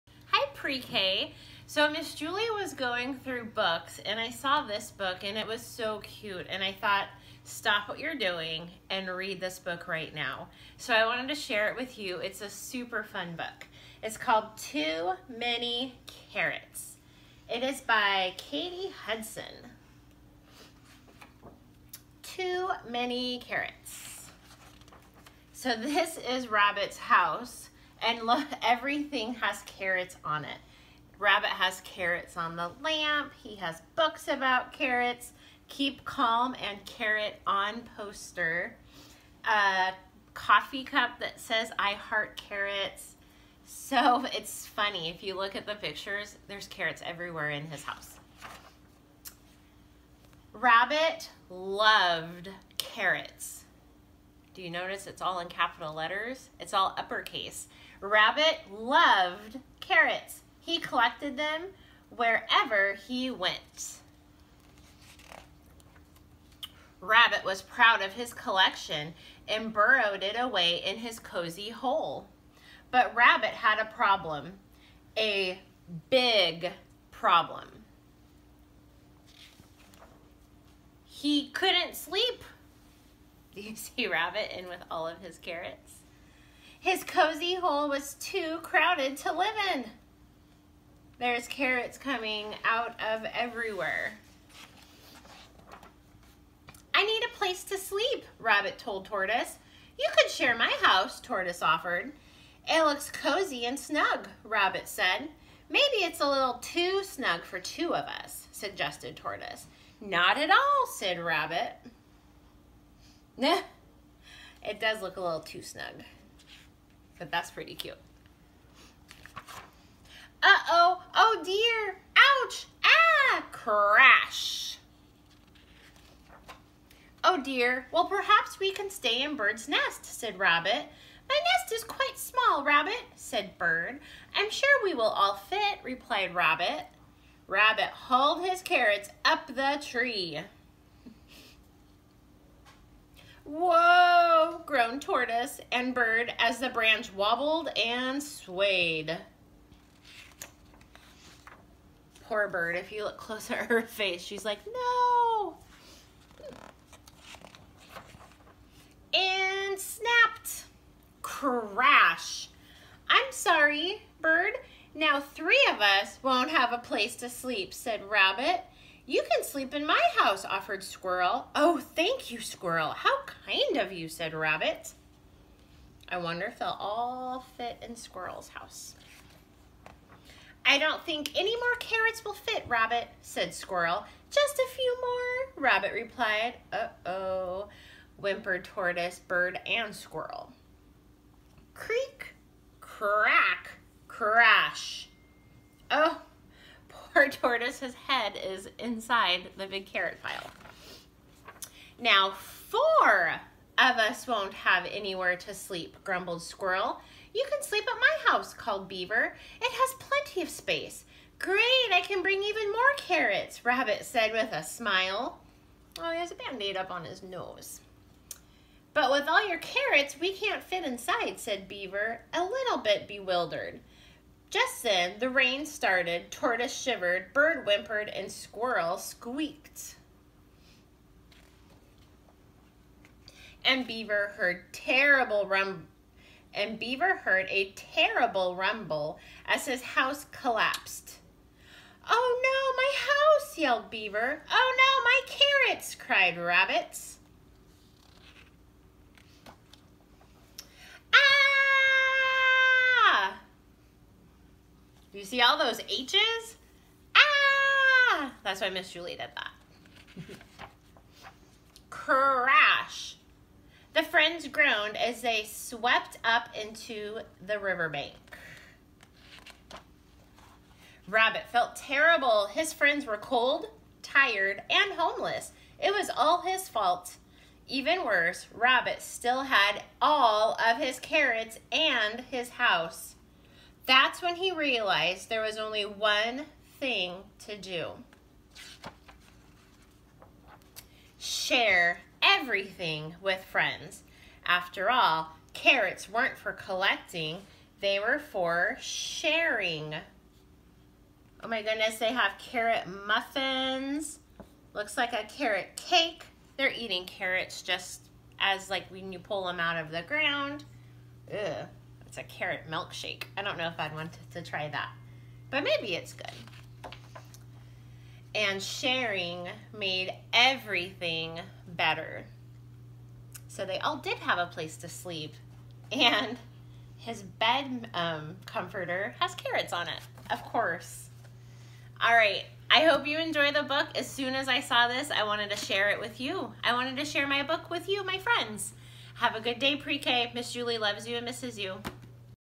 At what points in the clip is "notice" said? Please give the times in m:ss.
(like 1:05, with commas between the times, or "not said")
0:54.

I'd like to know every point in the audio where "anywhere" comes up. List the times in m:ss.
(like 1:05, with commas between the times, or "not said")
3:24.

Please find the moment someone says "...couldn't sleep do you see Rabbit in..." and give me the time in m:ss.
1:21.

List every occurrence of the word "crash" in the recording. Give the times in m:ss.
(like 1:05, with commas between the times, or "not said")
2:03, 2:41, 4:21.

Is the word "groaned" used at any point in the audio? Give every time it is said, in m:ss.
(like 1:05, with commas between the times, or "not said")
2:24, 4:24.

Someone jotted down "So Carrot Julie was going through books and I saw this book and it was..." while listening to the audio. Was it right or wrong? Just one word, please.
wrong.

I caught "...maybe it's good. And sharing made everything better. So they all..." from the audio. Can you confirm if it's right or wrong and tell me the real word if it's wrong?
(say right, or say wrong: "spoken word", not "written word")
right.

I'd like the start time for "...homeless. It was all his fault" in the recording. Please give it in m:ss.
4:34.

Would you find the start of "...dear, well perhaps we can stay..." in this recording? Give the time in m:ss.
2:07.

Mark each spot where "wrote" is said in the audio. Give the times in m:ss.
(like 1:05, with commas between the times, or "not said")
not said.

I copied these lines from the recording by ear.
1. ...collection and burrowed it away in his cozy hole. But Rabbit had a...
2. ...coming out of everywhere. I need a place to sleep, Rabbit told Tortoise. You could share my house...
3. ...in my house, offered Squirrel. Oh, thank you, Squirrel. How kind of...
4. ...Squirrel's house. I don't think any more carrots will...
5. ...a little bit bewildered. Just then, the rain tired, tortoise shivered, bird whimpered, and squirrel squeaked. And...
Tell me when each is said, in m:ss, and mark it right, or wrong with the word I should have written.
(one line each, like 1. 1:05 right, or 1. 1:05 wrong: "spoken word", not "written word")
1. 1:08 right
2. 1:31 right
3. 2:49 right
4. 2:57 right
5. 3:42 wrong: "started", not "tired".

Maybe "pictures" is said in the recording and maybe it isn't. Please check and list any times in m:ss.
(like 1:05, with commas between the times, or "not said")
0:45.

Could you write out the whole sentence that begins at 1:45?
Maybe it's a little too snug for two of us, suggested Tortoise.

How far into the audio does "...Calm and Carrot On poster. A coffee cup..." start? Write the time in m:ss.
0:36.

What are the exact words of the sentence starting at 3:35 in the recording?
Oh, he has a band-aid up on his nose.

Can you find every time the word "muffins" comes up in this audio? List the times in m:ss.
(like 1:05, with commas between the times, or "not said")
5:03.